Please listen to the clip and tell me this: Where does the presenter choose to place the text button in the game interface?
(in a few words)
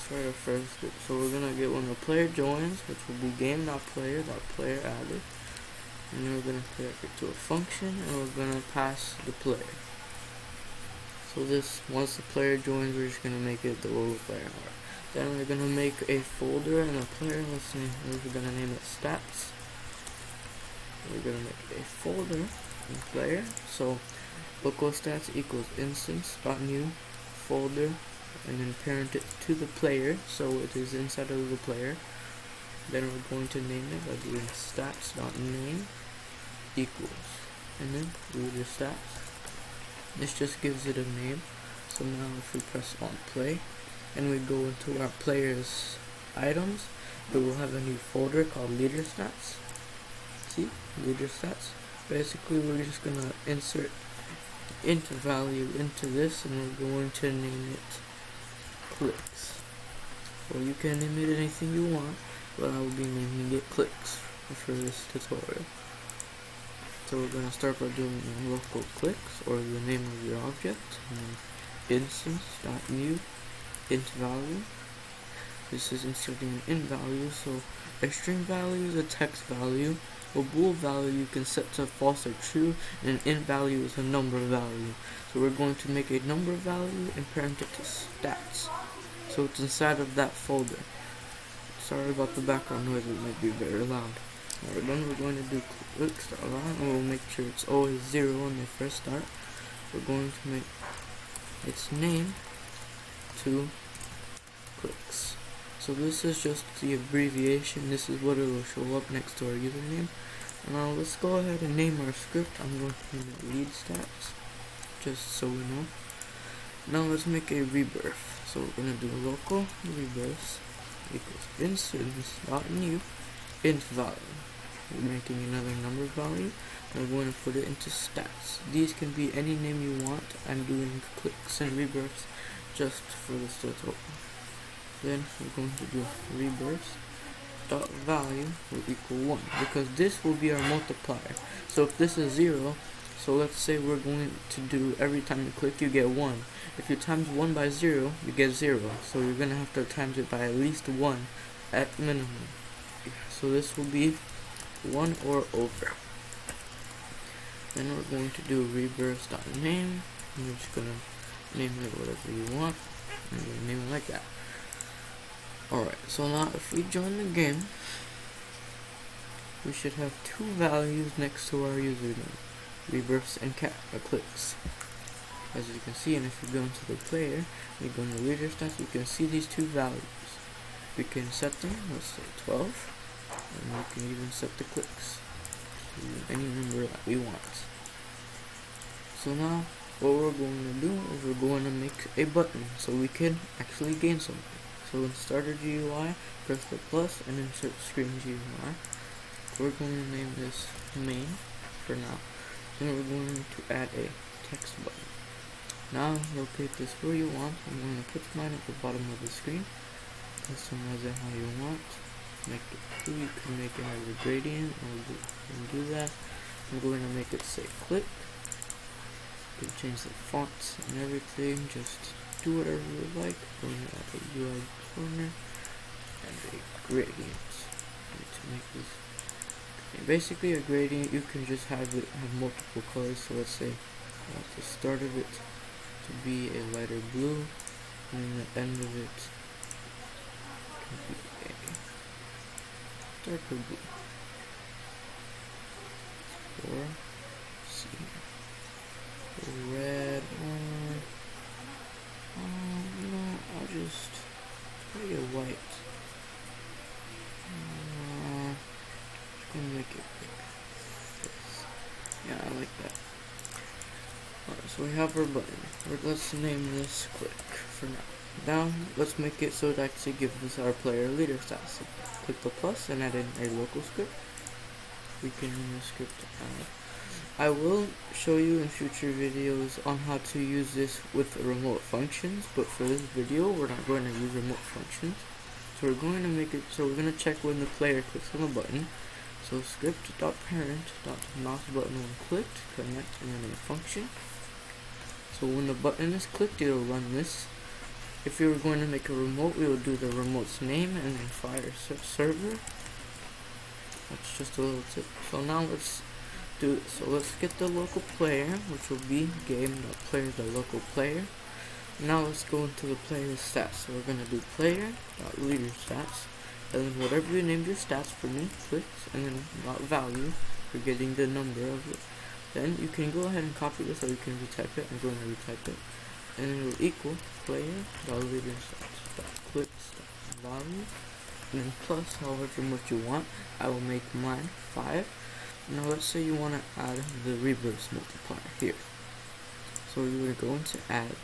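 bottom of the screen.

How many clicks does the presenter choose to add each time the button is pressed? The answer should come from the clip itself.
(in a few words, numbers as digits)
5.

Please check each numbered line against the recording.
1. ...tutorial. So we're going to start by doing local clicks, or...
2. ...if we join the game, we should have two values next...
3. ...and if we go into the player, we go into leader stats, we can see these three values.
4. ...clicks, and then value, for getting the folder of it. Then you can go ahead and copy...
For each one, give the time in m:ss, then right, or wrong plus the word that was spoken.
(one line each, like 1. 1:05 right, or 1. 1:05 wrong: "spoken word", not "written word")
1. 1:05 right
2. 2:46 right
3. 2:56 wrong: "two", not "three"
4. 5:18 wrong: "number", not "folder".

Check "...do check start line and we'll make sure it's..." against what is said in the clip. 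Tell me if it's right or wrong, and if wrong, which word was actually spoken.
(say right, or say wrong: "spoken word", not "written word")
wrong: "click", not "check".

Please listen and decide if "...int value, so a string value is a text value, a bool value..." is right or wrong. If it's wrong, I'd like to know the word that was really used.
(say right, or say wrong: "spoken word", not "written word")
right.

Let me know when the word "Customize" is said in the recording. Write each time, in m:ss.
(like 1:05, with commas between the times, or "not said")
3:30.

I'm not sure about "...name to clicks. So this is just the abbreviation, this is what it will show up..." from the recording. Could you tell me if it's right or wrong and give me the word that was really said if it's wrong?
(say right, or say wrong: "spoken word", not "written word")
right.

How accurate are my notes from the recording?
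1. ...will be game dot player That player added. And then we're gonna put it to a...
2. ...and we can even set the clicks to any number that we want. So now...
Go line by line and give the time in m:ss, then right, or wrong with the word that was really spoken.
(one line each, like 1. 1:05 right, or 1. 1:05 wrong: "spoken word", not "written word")
1. 0:03 right
2. 3:02 right.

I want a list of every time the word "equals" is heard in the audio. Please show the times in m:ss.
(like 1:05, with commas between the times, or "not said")
0:25, 0:36, 2:01, 2:18, 5:26.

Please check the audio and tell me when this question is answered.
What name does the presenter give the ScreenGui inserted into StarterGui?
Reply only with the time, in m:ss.
3:19.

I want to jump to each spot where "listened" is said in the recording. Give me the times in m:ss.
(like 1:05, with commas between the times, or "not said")
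not said.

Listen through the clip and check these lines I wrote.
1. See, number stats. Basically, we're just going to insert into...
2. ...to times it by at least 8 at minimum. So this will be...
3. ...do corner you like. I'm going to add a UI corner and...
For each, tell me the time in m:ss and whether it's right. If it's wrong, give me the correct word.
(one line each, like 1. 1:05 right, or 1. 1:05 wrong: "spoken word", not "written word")
1. 0:50 wrong: "leader", not "number"
2. 2:29 wrong: "1", not "8"
3. 3:42 wrong: "whatever", not "corner".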